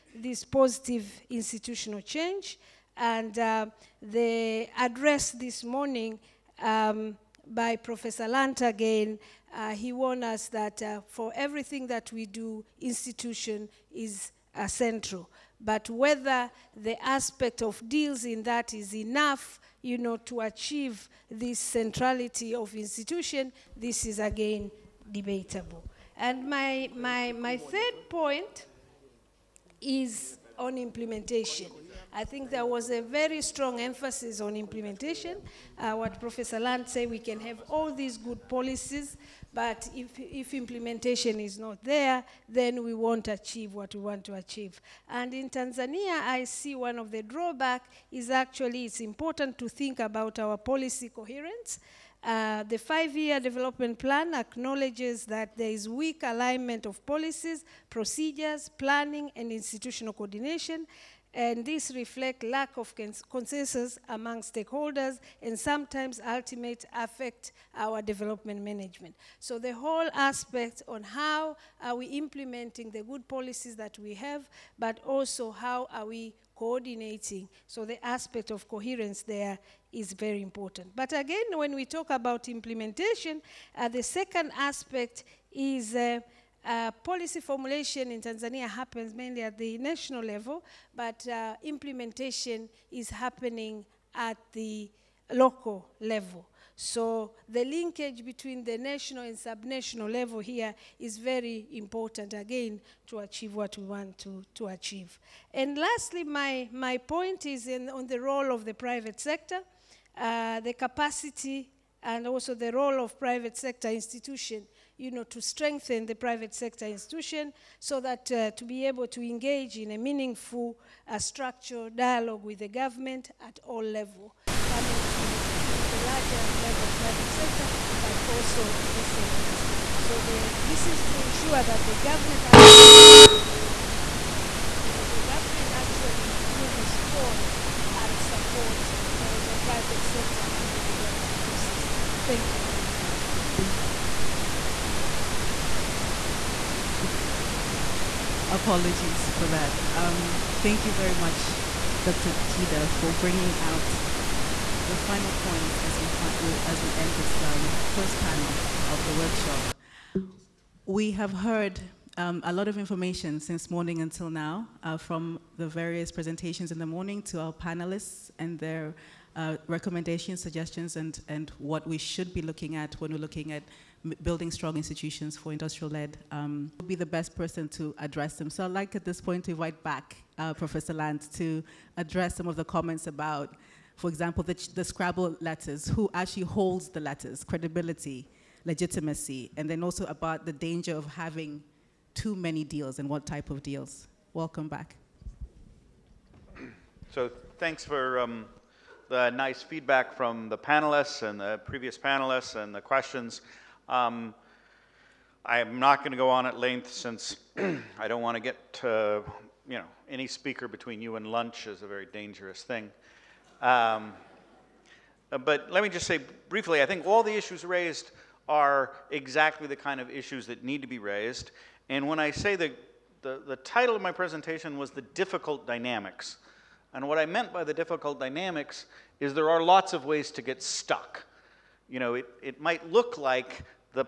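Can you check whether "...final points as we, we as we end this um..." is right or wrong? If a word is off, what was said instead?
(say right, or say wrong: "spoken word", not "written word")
right.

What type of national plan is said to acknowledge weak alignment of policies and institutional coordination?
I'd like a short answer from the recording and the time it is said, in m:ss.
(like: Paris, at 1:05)
five-year development plan, at 0:52.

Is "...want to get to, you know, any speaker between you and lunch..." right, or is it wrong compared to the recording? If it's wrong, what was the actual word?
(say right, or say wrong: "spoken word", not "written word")
right.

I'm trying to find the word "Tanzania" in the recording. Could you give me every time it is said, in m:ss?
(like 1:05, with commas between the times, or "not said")
0:45, 1:28.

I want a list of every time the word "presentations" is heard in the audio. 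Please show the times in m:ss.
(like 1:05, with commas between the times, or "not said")
2:46, 3:44.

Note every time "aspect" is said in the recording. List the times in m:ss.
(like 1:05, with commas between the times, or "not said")
0:17, 1:10, 1:18, 1:24.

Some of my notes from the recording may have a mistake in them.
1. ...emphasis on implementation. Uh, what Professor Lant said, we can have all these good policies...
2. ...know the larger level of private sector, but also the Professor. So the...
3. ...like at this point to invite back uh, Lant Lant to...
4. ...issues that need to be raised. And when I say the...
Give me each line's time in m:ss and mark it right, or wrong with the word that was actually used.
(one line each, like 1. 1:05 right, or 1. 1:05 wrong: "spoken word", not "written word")
1. 0:33 right
2. 2:05 wrong: "SMEs", not "Professor"
3. 2:58 wrong: "Professor", not "Lant"
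4. 3:40 right.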